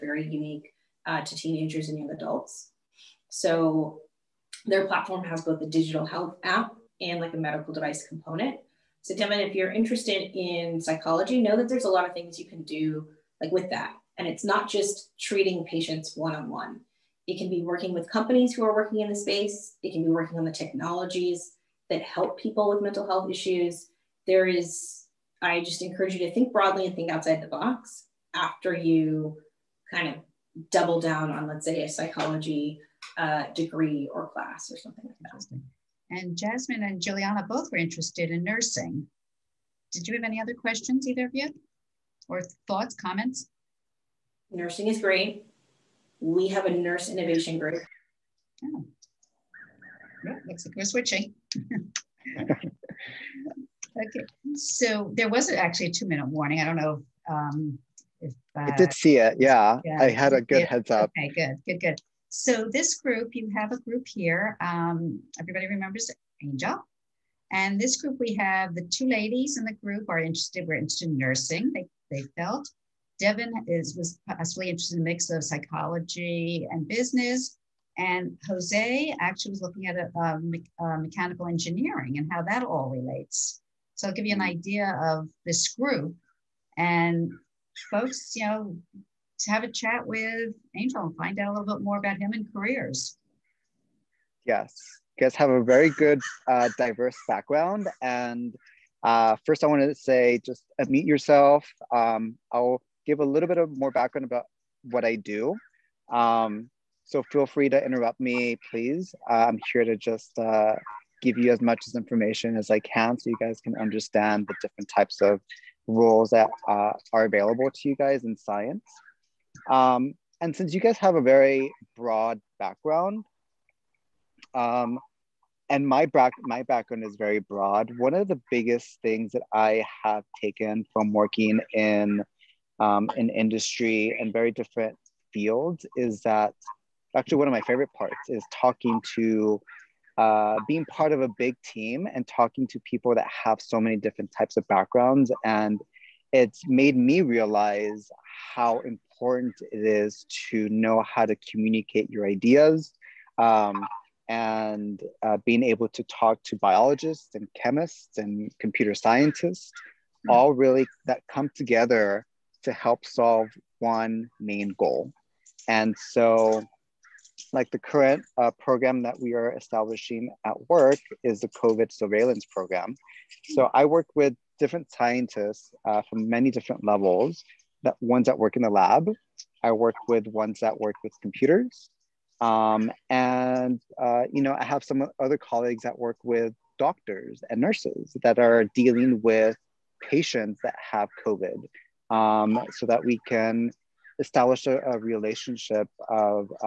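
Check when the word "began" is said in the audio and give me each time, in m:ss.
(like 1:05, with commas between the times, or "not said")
not said.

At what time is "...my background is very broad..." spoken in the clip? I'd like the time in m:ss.
2:06.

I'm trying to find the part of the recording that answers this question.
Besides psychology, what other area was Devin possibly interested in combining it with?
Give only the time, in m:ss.
1:16.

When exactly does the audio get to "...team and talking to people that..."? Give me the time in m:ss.
2:21.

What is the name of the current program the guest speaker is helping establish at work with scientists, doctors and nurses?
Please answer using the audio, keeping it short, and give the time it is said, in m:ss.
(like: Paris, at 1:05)
COVID surveillance program, at 2:51.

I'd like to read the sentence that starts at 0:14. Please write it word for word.
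And it's not just treating patients one-on-one.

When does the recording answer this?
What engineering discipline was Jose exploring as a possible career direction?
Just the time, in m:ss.
1:20.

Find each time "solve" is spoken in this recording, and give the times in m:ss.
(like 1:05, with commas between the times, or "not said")
2:43.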